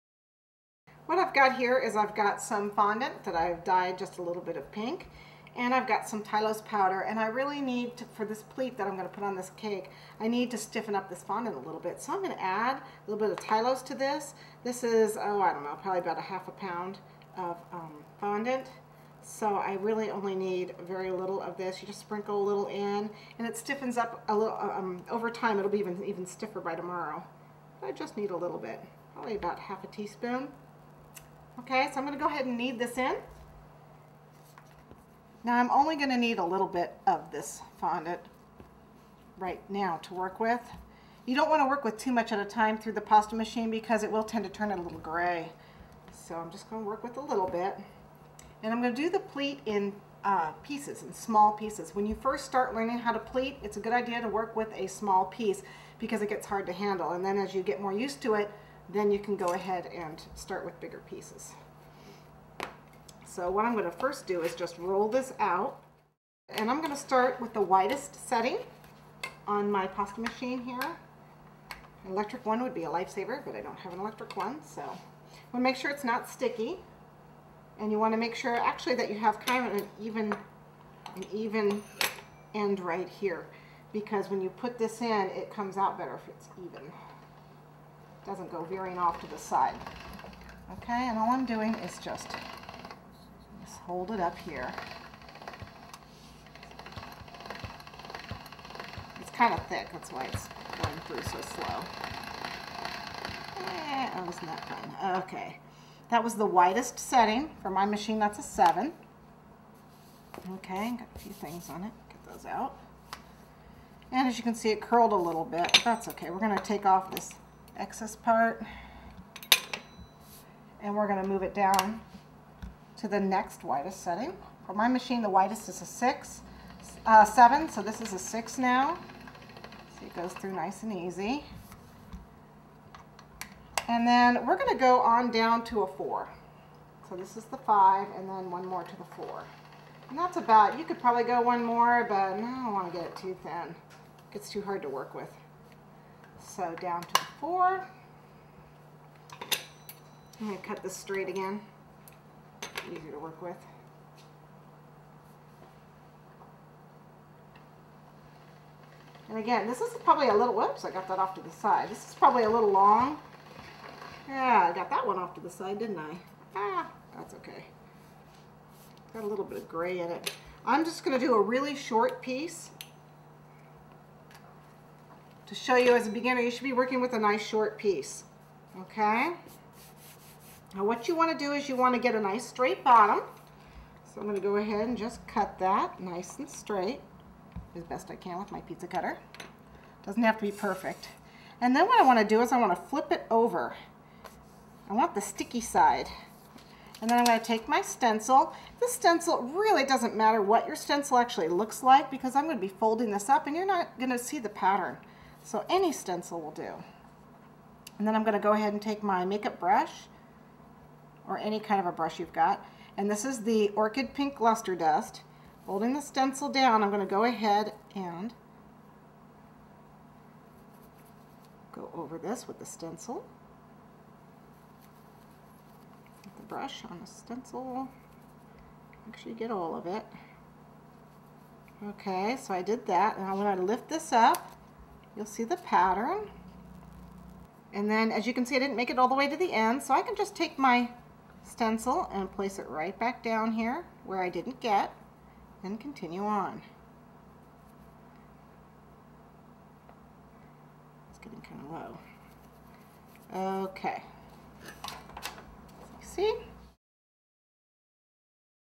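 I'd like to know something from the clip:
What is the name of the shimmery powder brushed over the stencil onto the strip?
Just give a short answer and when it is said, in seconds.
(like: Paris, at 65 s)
Orchid Pink Luster Dust, at 213 s.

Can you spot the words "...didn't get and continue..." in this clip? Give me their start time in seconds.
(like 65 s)
244 s.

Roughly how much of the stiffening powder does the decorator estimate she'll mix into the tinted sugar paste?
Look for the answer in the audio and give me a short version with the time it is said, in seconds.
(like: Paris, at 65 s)
half a teaspoon, at 29 s.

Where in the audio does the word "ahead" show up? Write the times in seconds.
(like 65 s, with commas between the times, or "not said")
32 s, 59 s, 184 s, 208 s, 217 s.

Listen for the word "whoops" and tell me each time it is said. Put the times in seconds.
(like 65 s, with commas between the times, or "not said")
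160 s.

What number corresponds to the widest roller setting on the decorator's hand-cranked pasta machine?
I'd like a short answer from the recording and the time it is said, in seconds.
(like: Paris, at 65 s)
7, at 108 s.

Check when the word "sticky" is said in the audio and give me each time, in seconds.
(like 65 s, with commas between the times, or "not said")
76 s, 195 s.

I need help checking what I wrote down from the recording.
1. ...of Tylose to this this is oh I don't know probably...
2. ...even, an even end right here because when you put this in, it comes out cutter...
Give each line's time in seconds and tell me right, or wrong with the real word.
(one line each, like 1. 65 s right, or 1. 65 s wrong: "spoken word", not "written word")
1. 13 s right
2. 79 s wrong: "better", not "cutter".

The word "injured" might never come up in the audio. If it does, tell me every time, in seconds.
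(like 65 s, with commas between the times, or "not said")
not said.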